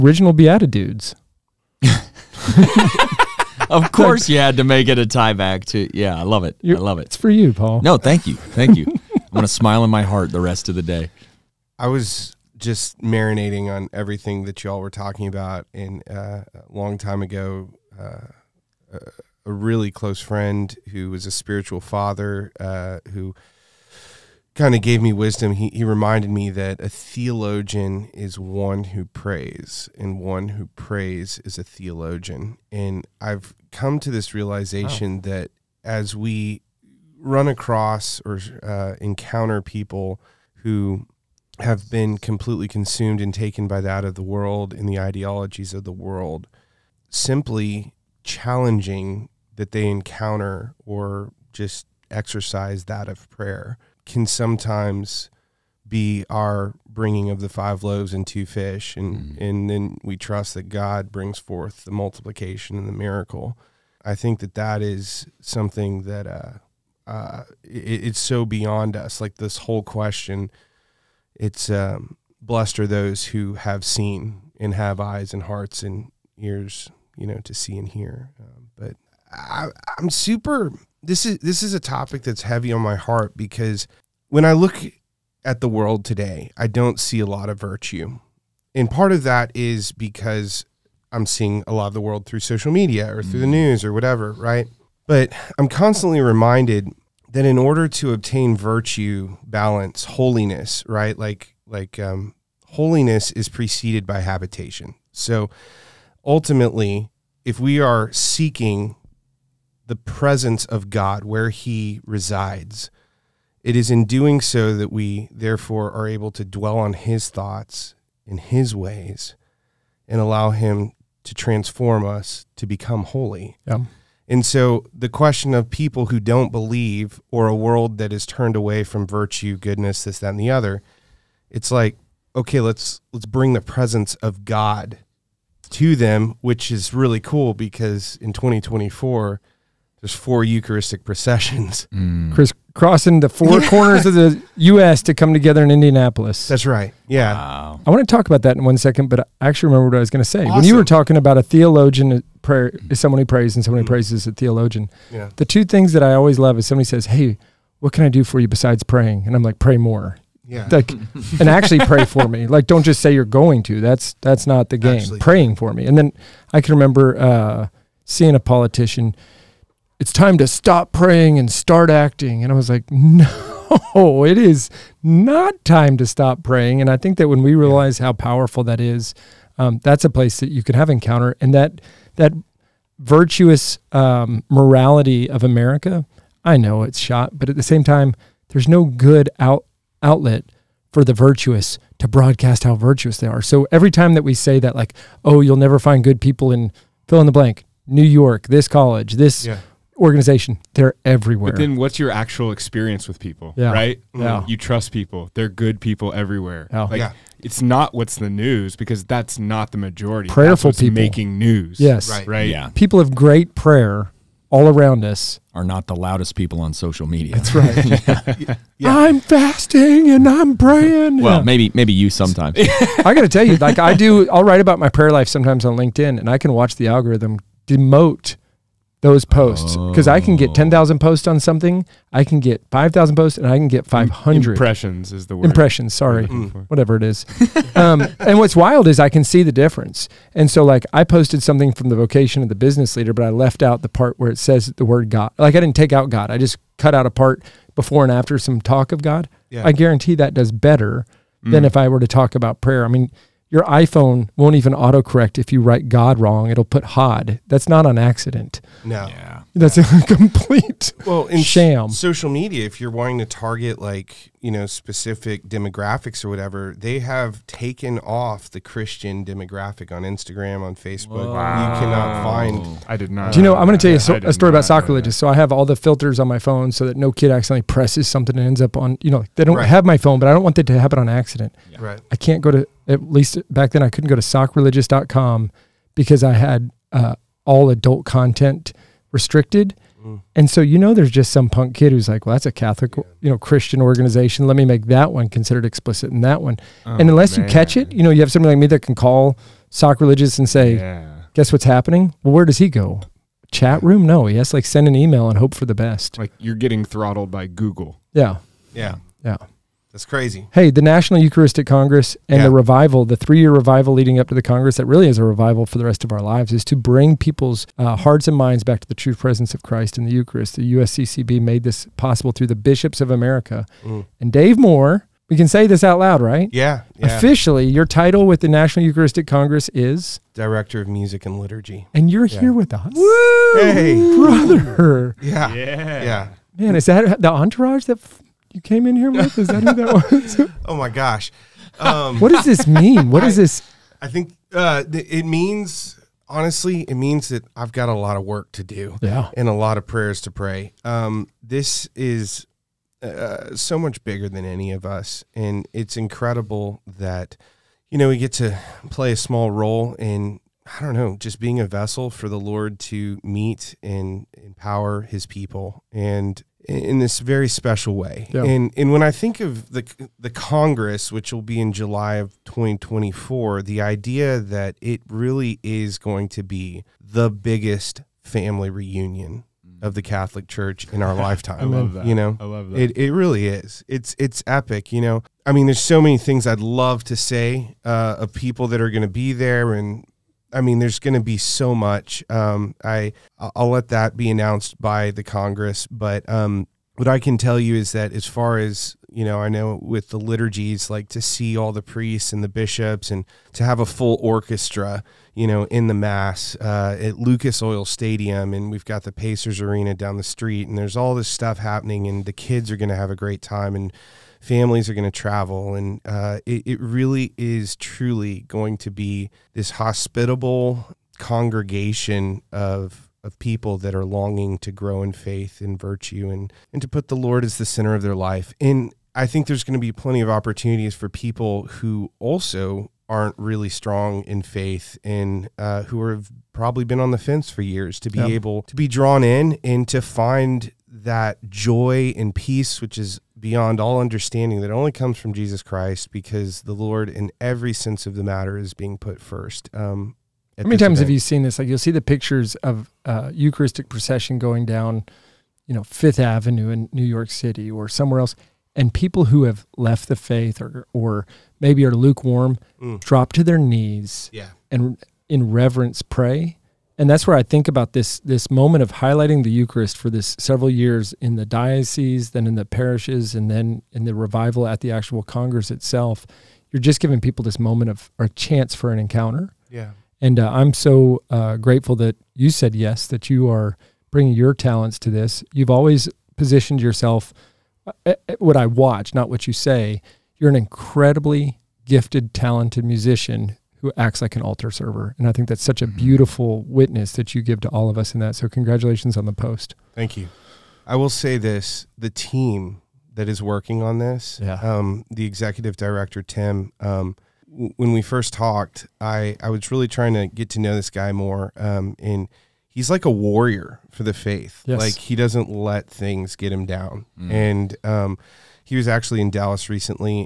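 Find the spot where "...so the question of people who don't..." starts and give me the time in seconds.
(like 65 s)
124 s.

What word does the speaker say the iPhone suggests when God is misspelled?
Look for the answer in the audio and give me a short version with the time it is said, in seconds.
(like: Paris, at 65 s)
Hod, at 256 s.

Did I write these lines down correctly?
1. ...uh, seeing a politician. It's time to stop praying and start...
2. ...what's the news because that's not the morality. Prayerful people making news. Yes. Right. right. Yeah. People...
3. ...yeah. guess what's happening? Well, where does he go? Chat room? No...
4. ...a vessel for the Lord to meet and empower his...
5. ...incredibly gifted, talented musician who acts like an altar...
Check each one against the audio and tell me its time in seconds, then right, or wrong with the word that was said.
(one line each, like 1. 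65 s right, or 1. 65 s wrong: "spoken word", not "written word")
1. 167 s right
2. 207 s wrong: "majority", not "morality"
3. 300 s right
4. 361 s right
5. 490 s right.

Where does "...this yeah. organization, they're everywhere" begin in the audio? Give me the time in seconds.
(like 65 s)
199 s.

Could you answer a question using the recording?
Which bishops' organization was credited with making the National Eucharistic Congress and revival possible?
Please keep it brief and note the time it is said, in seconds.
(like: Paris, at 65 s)
USCCB, at 320 s.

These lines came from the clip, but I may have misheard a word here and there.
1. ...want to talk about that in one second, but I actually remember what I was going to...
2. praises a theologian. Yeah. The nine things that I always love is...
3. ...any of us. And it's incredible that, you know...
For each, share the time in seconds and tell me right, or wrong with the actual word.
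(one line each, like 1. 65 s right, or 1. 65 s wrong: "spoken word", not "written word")
1. 147 s right
2. 153 s wrong: "two", not "nine"
3. 354 s right.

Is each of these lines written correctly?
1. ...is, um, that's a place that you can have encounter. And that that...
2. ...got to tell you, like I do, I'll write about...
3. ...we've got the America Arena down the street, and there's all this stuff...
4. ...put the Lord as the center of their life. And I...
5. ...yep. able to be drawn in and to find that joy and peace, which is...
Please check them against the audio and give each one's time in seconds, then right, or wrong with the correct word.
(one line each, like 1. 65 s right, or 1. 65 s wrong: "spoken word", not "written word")
1. 178 s right
2. 223 s right
3. 408 s wrong: "Pacers", not "America"
4. 426 s right
5. 438 s right.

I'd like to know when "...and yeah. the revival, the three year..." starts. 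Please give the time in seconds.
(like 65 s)
312 s.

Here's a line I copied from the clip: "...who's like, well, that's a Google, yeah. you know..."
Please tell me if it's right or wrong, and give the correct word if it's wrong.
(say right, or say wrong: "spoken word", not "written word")
wrong: "Catholic", not "Google".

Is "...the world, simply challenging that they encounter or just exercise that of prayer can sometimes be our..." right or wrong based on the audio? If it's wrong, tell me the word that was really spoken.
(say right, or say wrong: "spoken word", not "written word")
right.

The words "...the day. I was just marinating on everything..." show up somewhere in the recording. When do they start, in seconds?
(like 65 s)
10 s.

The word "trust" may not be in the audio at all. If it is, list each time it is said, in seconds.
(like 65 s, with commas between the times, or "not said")
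60 s, 204 s.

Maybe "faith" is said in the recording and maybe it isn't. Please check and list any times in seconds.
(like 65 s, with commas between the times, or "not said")
425 s, 434 s, 460 s, 514 s.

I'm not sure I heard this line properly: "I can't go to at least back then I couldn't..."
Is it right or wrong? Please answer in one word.
right.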